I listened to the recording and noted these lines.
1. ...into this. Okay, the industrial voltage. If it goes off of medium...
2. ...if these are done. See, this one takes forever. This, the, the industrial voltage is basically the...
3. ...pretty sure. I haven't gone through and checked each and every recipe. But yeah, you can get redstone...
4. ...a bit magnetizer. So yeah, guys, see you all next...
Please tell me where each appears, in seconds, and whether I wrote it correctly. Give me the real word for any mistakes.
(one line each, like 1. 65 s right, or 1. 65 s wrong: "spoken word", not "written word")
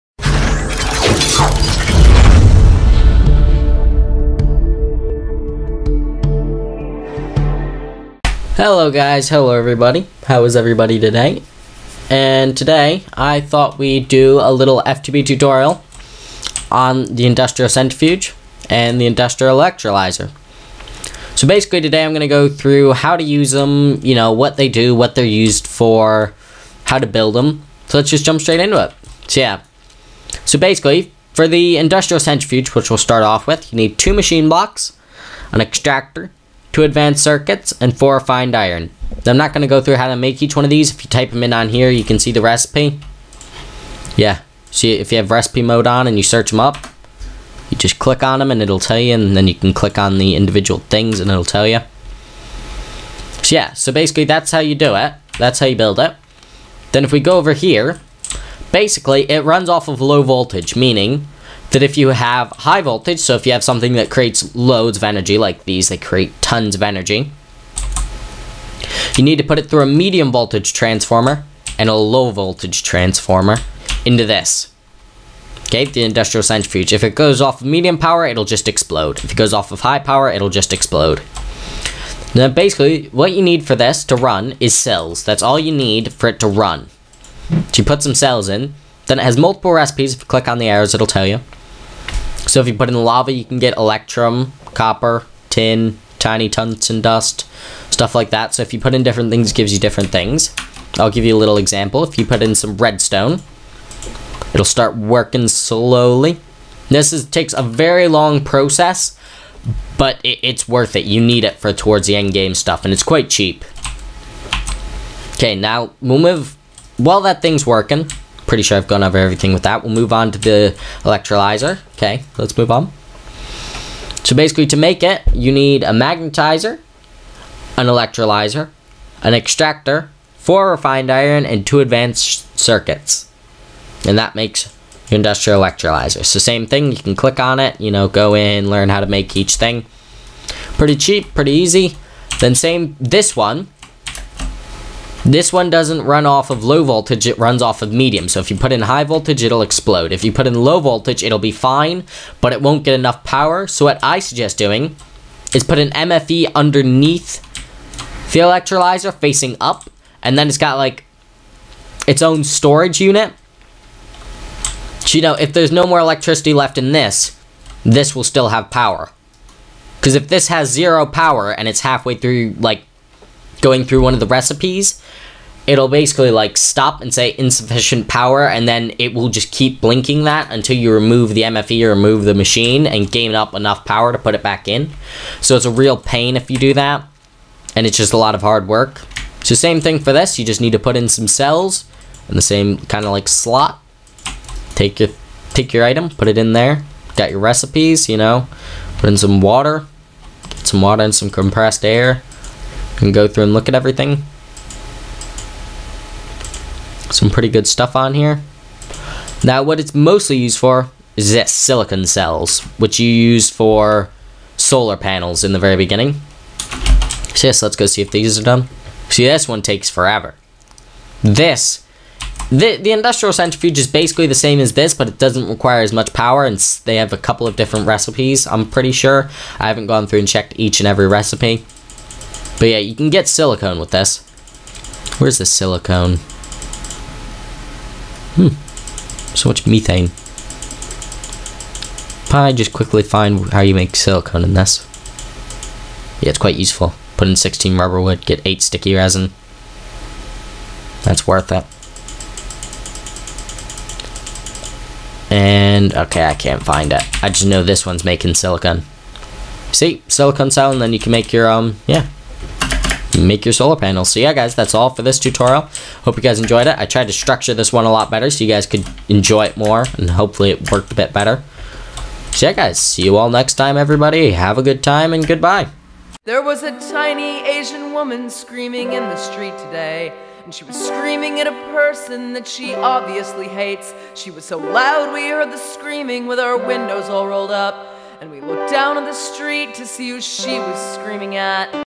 1. 74 s wrong: "centrifuge", not "voltage"
2. 218 s wrong: "centrifuge", not "voltage"
3. 228 s wrong: "silicone", not "redstone"
4. 270 s wrong: "better", not "magnetizer".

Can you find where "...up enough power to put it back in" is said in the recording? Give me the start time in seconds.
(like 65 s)
183 s.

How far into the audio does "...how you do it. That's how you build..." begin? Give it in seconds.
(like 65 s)
54 s.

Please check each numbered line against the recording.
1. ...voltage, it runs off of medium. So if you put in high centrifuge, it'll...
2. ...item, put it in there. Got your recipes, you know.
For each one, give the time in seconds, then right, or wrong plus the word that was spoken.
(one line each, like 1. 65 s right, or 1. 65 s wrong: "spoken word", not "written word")
1. 146 s wrong: "voltage", not "centrifuge"
2. 195 s right.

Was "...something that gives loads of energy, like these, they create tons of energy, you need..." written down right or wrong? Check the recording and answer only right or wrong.
wrong.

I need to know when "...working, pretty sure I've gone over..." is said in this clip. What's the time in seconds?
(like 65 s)
117 s.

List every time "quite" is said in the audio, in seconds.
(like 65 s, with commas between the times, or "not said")
113 s, 246 s.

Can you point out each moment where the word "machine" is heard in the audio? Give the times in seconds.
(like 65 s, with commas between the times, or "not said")
34 s, 182 s.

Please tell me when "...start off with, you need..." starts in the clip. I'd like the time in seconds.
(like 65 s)
32 s.